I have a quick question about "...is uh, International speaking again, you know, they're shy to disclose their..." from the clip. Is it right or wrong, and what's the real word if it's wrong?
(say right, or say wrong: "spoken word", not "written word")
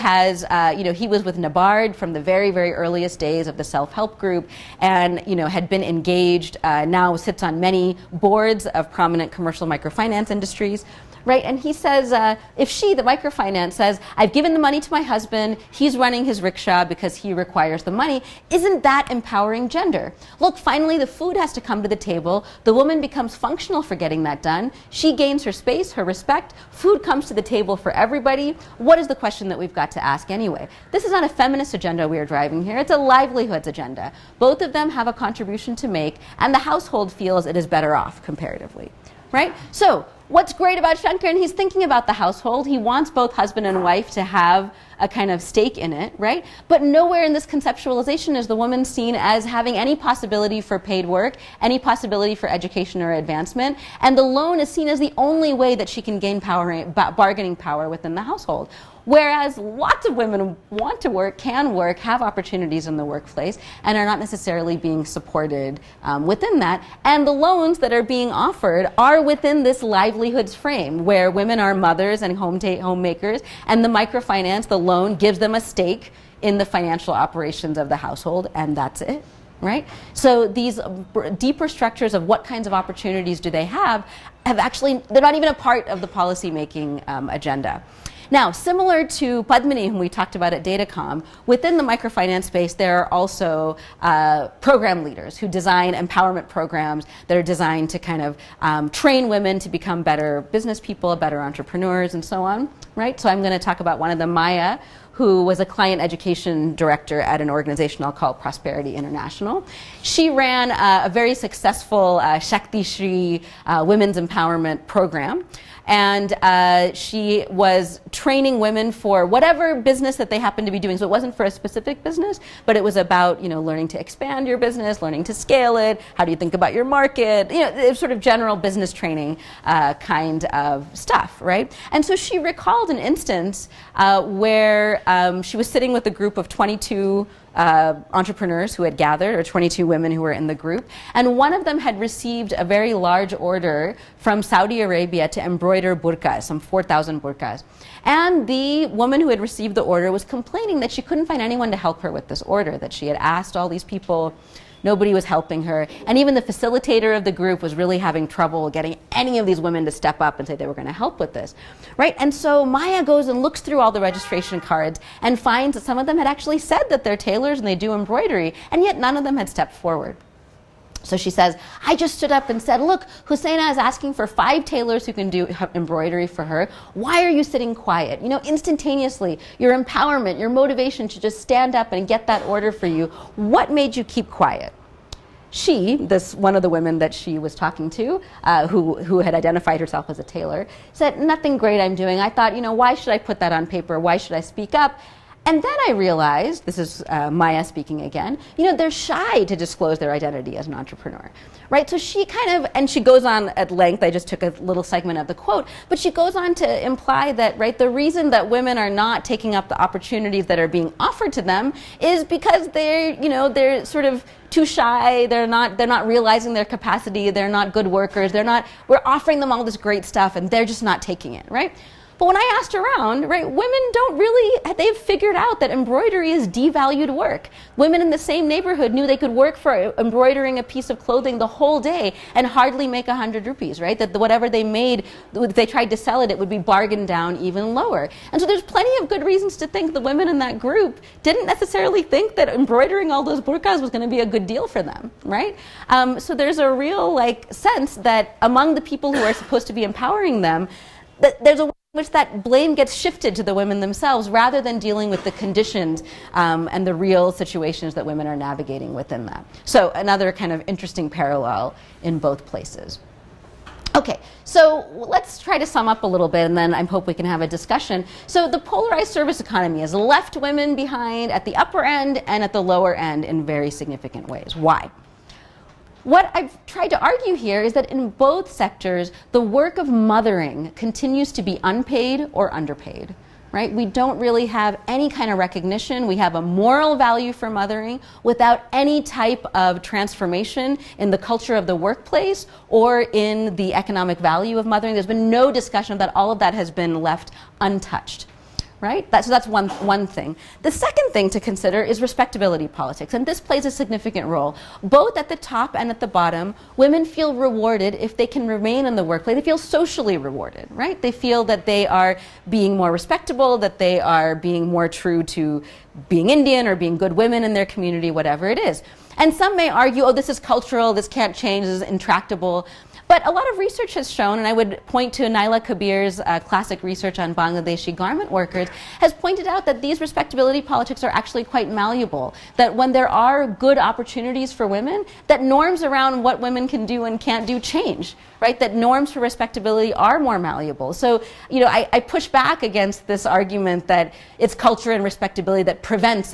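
wrong: "Maya", not "International".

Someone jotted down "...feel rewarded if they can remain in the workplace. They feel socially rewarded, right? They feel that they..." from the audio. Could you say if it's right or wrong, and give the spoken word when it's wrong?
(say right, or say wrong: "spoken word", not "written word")
right.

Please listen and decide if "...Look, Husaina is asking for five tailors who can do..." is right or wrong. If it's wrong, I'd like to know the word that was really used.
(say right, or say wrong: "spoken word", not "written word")
right.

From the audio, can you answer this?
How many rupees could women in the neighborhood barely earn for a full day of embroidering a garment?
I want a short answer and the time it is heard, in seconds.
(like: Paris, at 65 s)
100 rupees, at 233 s.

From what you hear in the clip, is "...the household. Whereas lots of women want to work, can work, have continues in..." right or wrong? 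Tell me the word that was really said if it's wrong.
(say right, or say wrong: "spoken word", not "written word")
wrong: "opportunities", not "continues".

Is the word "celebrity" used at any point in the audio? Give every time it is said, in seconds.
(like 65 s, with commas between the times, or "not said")
not said.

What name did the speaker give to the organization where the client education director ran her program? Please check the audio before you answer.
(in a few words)
Prosperity International.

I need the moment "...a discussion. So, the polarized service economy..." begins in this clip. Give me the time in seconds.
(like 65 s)
267 s.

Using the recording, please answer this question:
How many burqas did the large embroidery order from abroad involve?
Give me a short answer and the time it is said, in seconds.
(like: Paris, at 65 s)
4,000, at 146 s.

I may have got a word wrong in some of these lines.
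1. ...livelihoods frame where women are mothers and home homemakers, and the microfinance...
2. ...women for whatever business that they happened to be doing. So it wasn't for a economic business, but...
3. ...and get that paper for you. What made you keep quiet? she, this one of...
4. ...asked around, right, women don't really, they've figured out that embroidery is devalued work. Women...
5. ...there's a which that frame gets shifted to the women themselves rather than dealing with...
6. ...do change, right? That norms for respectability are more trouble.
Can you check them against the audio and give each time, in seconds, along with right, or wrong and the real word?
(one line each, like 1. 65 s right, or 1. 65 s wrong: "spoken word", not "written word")
1. 69 s right
2. 118 s wrong: "specific", not "economic"
3. 181 s wrong: "order", not "paper"
4. 222 s right
5. 251 s wrong: "blame", not "frame"
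6. 337 s wrong: "malleable", not "trouble".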